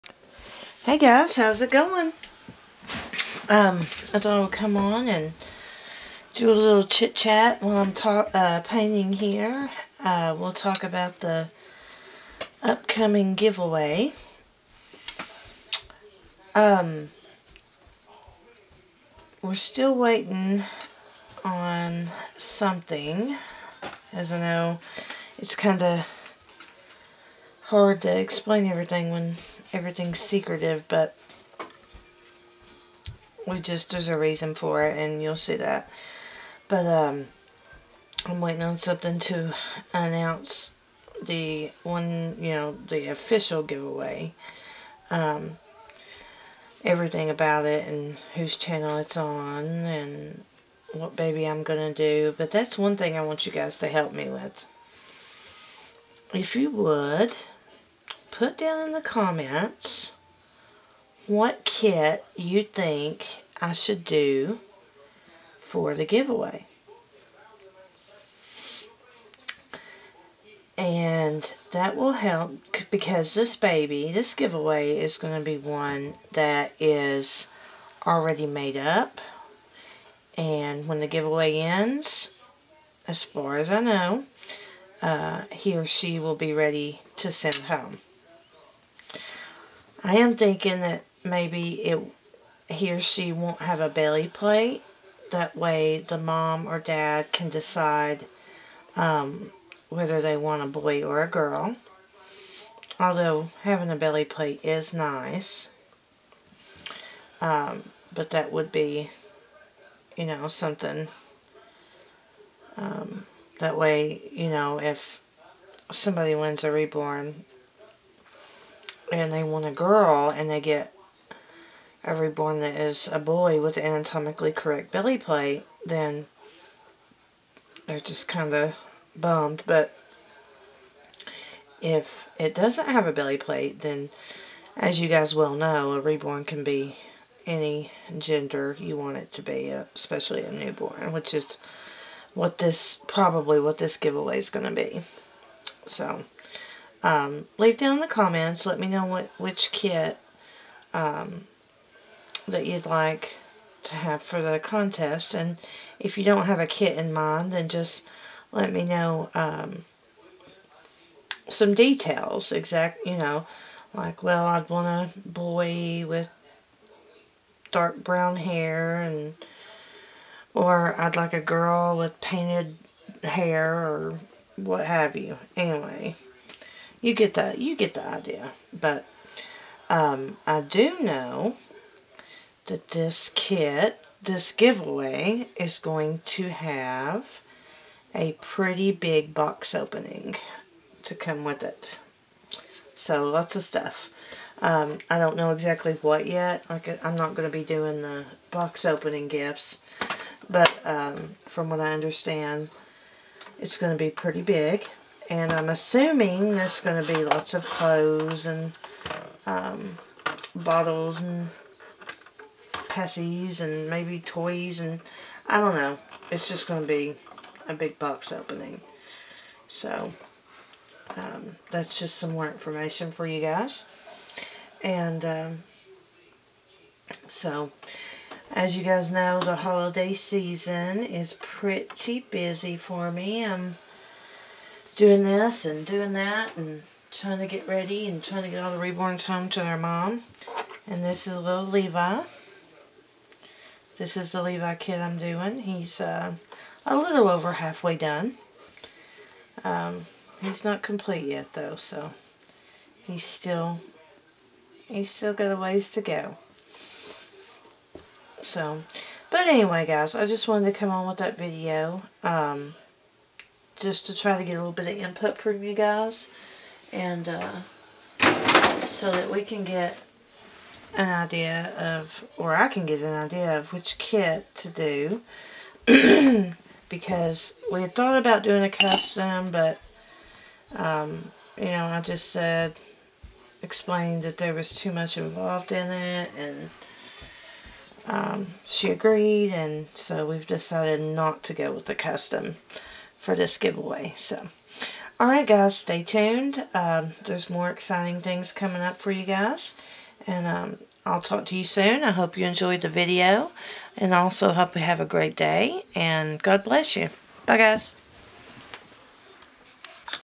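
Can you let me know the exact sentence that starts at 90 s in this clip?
I am thinking that maybe it he or she won't have a belly plate.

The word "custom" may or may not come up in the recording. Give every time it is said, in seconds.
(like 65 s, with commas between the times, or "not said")
278 s, 291 s.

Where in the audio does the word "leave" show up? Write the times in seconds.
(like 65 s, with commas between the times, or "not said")
147 s.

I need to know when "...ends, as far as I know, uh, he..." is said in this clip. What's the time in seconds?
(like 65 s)
81 s.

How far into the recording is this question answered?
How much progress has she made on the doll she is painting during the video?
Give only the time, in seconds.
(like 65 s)
246 s.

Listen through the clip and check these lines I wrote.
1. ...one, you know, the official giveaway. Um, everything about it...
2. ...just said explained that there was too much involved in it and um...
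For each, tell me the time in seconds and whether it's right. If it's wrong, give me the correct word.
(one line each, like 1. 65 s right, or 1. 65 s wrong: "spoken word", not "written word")
1. 41 s right
2. 282 s right.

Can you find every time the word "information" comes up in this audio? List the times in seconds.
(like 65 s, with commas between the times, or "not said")
222 s.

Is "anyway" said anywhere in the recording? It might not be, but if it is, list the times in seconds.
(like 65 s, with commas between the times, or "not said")
175 s, 259 s.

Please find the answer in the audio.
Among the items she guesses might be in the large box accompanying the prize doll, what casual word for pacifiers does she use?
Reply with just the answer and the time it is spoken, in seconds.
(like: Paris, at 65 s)
passies, at 212 s.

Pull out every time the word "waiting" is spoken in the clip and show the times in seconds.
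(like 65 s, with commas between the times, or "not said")
19 s, 38 s.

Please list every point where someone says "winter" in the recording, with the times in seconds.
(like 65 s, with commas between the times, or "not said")
not said.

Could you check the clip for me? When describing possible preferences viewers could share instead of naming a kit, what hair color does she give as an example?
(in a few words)
dark brown.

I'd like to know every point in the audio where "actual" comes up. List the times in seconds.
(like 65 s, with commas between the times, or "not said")
not said.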